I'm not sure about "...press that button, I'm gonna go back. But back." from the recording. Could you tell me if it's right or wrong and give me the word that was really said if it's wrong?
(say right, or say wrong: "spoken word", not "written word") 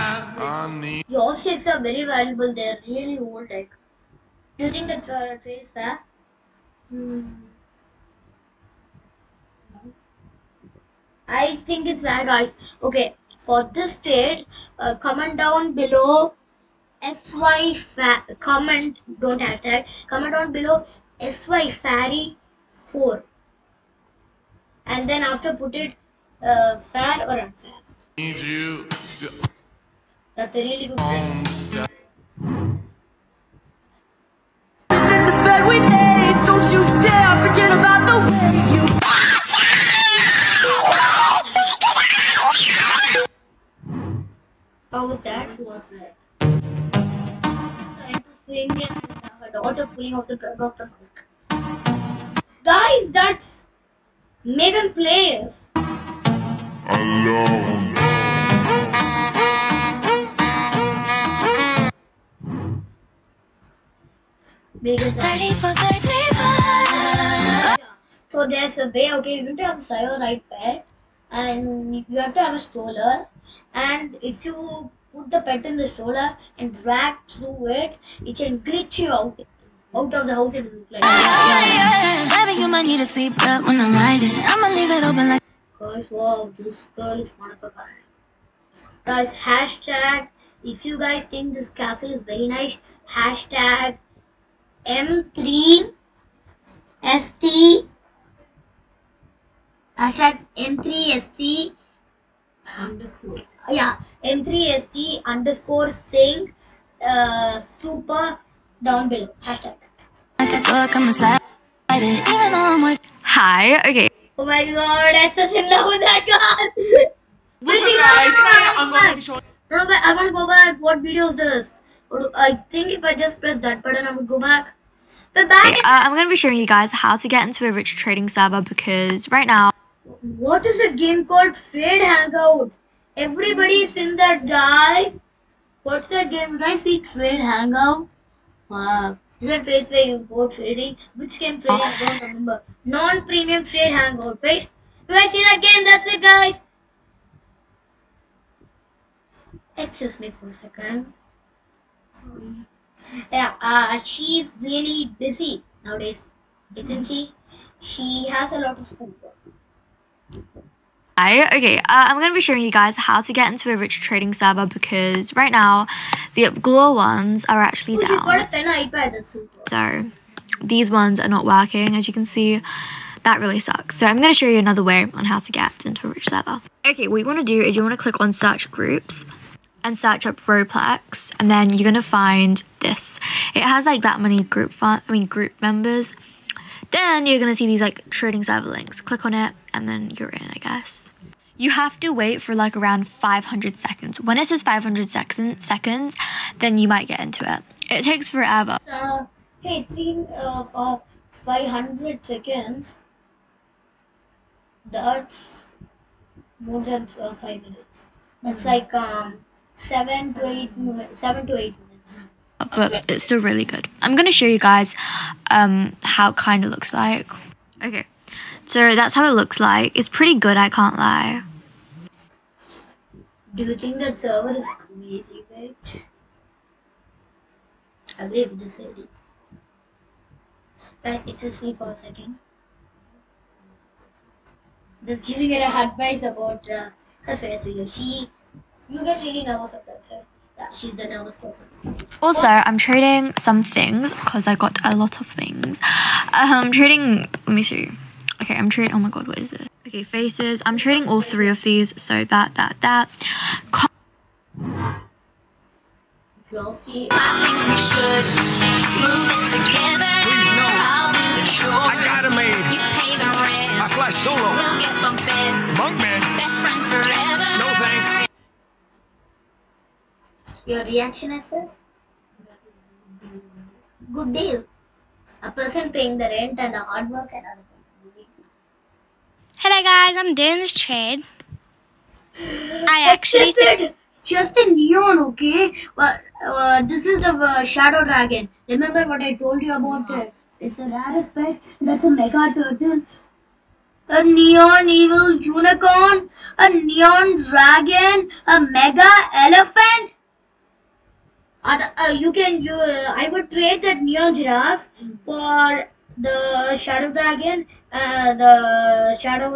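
right.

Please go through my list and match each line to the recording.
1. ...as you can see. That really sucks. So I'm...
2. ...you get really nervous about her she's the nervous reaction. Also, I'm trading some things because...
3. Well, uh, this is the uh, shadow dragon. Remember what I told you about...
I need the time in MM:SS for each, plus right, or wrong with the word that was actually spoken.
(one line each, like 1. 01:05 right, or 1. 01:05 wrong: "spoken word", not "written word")
1. 02:51 right
2. 03:58 wrong: "person", not "reaction"
3. 04:45 right.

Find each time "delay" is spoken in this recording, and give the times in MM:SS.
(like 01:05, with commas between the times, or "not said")
not said.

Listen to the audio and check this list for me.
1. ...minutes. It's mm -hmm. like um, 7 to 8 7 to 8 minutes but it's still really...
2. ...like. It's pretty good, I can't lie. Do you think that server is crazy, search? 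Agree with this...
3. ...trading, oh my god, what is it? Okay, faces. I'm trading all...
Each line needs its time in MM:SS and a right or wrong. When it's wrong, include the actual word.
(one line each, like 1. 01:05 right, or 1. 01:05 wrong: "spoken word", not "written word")
1. 03:27 right
2. 03:39 wrong: "bitch", not "search"
3. 04:08 right.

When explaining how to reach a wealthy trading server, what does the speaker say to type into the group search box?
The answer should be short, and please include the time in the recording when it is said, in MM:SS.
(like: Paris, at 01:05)
Roblox, at 02:59.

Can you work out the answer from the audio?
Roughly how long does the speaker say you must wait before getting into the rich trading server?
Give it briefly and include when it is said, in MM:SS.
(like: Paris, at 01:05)
500 seconds, at 03:12.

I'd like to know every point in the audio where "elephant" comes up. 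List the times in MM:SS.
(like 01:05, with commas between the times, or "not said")
04:59.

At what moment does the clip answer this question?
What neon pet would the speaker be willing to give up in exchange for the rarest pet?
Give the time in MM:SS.
05:04.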